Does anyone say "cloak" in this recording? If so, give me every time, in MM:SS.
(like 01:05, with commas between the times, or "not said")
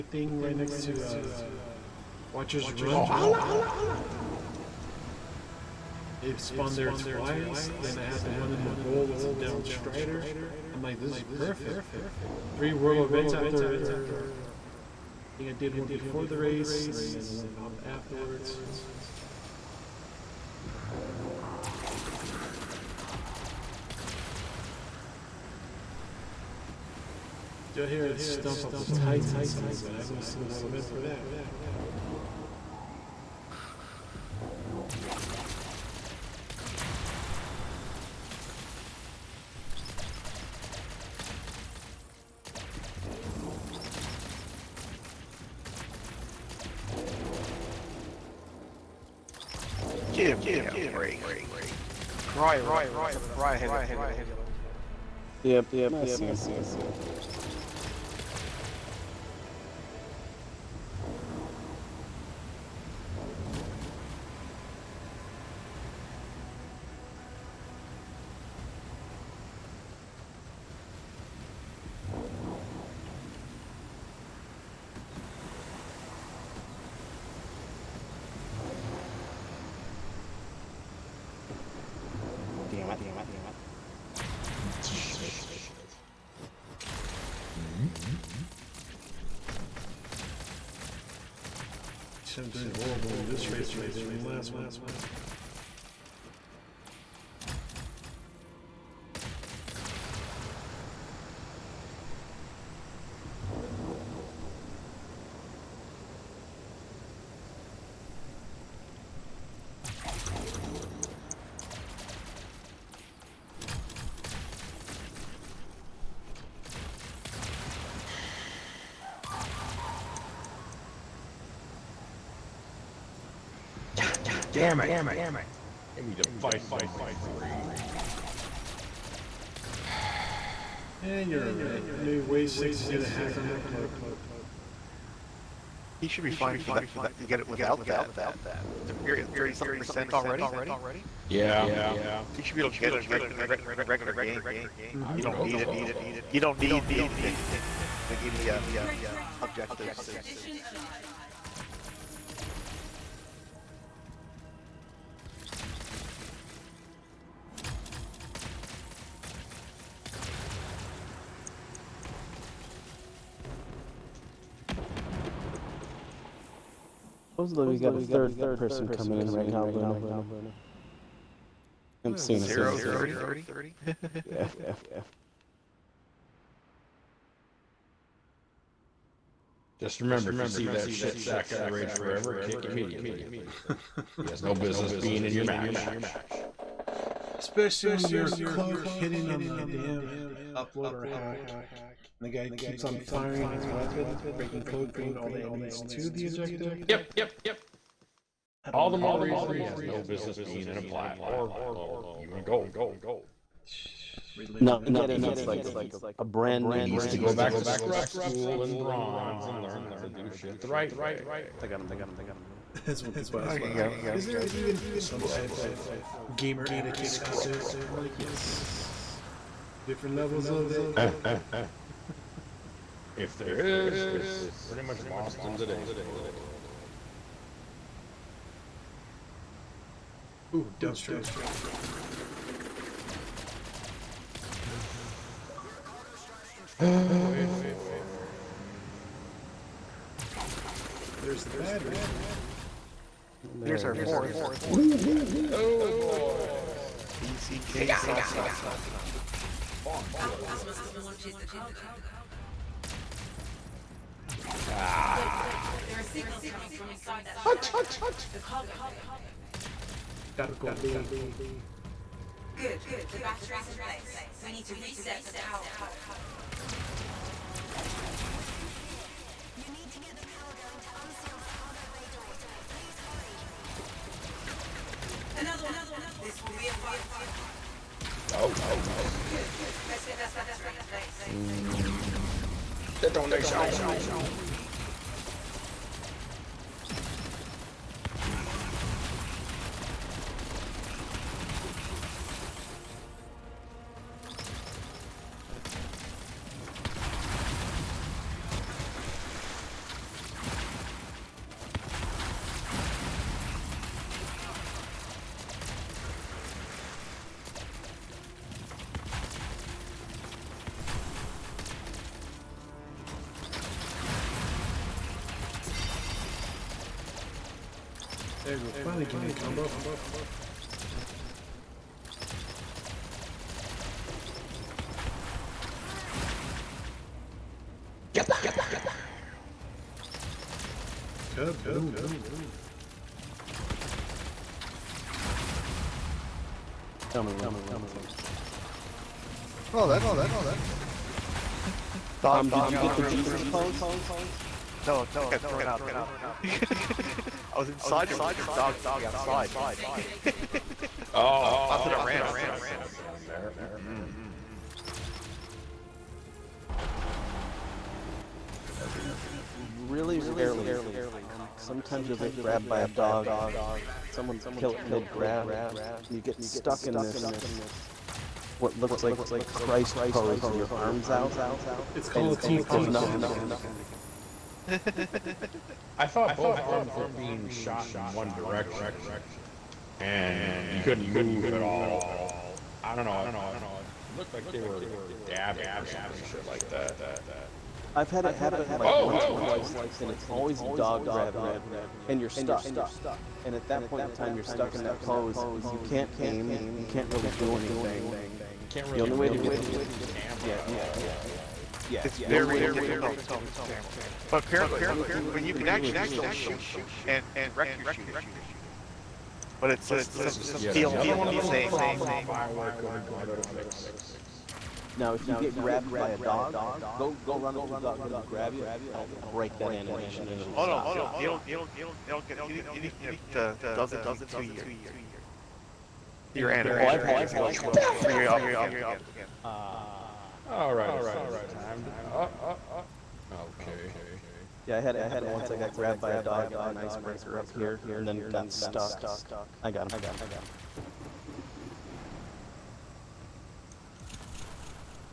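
03:08, 03:14.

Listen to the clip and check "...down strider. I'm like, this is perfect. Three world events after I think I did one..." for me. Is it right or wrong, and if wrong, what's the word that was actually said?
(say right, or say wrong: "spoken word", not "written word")
right.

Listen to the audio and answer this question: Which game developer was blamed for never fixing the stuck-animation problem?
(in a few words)
Bioware.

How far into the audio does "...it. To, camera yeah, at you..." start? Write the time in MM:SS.
06:39.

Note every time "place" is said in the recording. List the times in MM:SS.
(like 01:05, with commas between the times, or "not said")
04:23, 04:41.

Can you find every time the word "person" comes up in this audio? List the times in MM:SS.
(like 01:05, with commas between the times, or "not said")
02:48.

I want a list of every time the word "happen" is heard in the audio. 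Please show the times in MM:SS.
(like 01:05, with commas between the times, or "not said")
06:28, 07:15.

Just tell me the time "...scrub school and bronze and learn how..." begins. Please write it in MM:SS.
03:27.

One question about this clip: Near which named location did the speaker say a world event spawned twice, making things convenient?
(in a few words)
Watchers Run.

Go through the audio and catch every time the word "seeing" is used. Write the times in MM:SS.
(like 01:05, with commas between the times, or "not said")
02:52.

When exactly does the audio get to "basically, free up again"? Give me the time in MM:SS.
07:07.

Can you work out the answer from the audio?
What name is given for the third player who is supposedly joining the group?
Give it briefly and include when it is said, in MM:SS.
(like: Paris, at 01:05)
Luna, at 02:49.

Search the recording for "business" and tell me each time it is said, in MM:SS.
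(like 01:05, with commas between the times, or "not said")
03:04, 03:20.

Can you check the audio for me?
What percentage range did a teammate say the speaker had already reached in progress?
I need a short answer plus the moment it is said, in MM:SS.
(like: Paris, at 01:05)
30 something percent, at 02:19.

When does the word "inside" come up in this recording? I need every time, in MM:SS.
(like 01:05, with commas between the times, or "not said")
04:16, 05:47.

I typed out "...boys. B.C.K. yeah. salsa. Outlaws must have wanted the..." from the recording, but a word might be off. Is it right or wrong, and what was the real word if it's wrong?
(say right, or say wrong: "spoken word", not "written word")
right.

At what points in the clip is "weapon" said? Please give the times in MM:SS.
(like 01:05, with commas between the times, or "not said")
03:13.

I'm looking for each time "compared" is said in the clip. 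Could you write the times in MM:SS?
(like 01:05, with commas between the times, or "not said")
not said.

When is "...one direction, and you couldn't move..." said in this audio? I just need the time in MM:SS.
06:18.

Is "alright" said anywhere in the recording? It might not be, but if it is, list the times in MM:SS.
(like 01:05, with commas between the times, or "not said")
02:11, 07:10.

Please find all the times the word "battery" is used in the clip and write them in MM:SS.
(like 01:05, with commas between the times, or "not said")
04:01, 04:23, 04:40.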